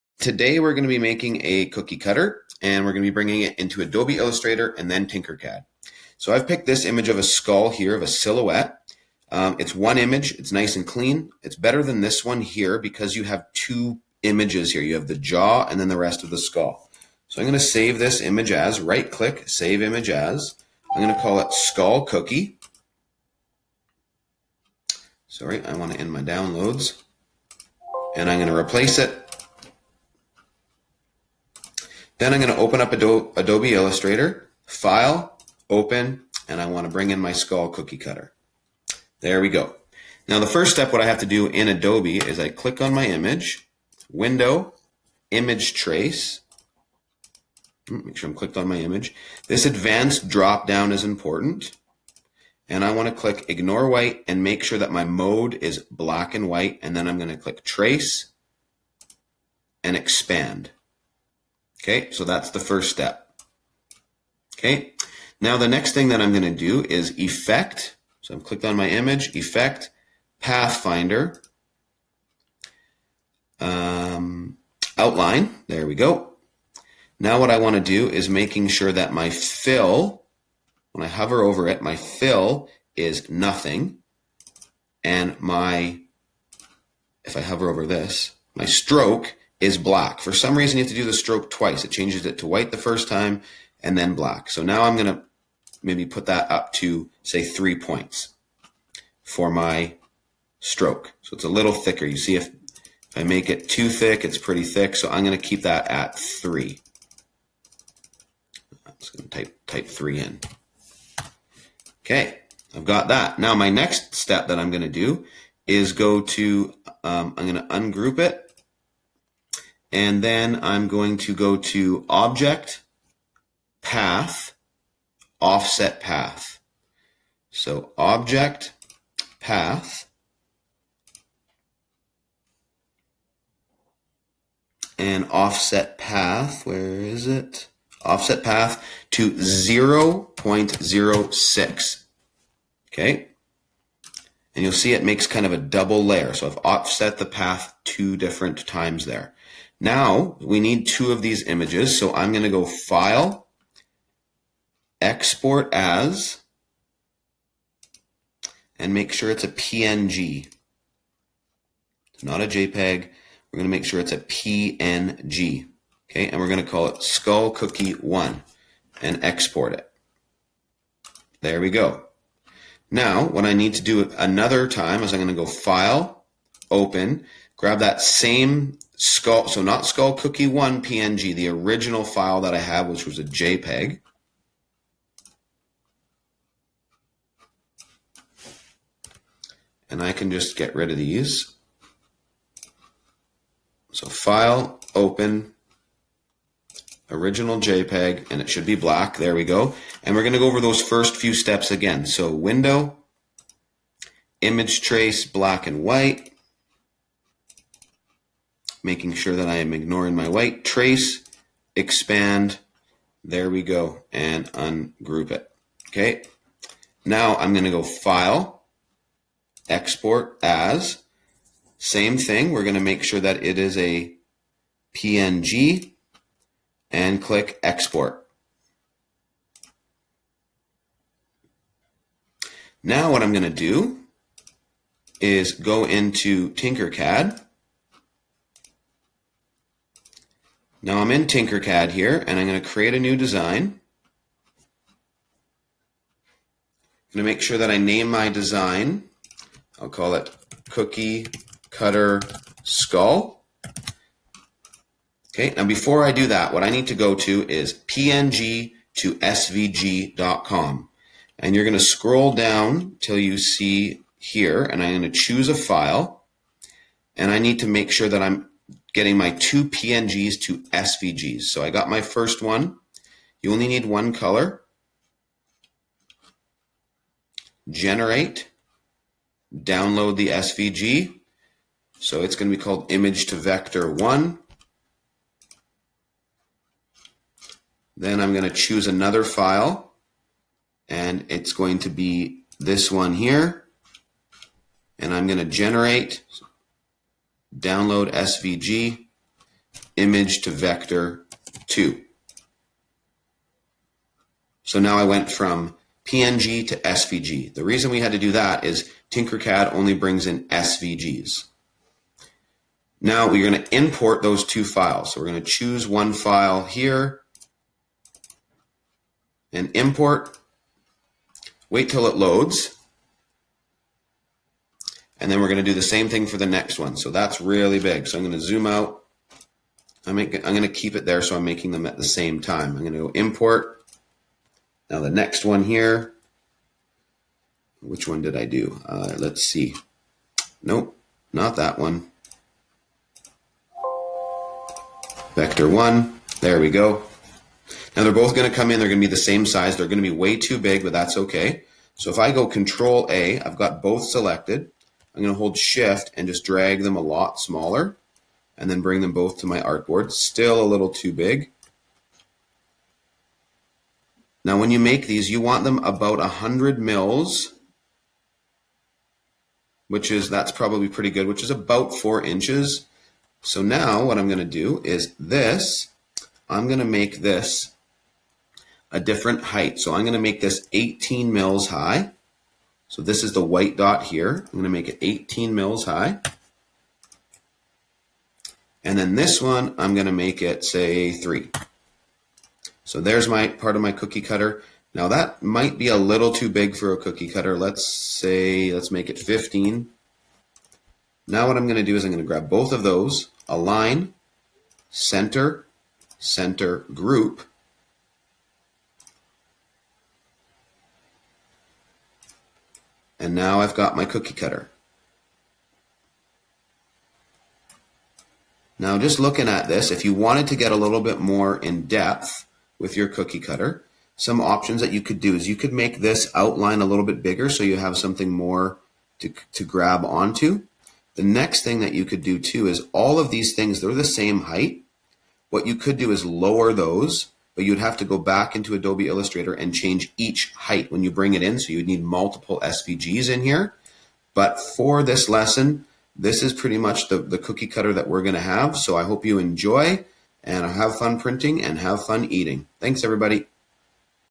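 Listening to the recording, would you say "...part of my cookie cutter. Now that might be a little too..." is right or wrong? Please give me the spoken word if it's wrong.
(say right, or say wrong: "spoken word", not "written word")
right.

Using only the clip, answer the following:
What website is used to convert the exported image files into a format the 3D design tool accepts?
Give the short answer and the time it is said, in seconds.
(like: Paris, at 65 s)
png to svg.com, at 257 s.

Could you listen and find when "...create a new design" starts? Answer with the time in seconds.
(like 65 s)
242 s.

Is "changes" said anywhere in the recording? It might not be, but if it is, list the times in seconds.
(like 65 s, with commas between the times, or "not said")
91 s, 439 s.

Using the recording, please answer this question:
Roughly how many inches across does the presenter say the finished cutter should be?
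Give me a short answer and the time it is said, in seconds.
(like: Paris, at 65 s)
4 inches, at 371 s.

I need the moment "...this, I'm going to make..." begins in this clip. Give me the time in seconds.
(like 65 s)
375 s.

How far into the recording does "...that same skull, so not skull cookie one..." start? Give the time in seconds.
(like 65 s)
177 s.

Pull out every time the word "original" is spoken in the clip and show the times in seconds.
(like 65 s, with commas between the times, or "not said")
181 s, 197 s.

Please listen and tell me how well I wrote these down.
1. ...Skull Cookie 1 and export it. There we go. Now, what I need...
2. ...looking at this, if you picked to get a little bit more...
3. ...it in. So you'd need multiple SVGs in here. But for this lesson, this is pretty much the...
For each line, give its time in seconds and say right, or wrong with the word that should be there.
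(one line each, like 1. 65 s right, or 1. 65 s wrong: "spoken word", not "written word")
1. 167 s right
2. 419 s wrong: "wanted", not "picked"
3. 441 s right.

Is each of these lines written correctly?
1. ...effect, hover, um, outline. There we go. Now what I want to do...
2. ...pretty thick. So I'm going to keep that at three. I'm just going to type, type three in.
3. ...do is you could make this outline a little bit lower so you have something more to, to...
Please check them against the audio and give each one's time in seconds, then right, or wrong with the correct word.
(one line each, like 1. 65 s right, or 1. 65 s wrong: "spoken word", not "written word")
1. 69 s wrong: "pathfinder", not "hover"
2. 104 s right
3. 425 s wrong: "bigger", not "lower".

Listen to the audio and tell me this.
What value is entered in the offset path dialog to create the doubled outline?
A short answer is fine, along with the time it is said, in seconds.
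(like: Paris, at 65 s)
0.06, at 139 s.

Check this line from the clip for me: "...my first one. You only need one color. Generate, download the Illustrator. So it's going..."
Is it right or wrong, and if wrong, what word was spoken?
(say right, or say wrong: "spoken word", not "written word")
wrong: "SVG", not "Illustrator".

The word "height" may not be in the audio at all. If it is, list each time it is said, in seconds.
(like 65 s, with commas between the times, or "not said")
379 s, 434 s, 440 s.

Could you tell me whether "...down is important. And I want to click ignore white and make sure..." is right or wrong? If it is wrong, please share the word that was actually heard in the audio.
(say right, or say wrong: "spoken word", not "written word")
right.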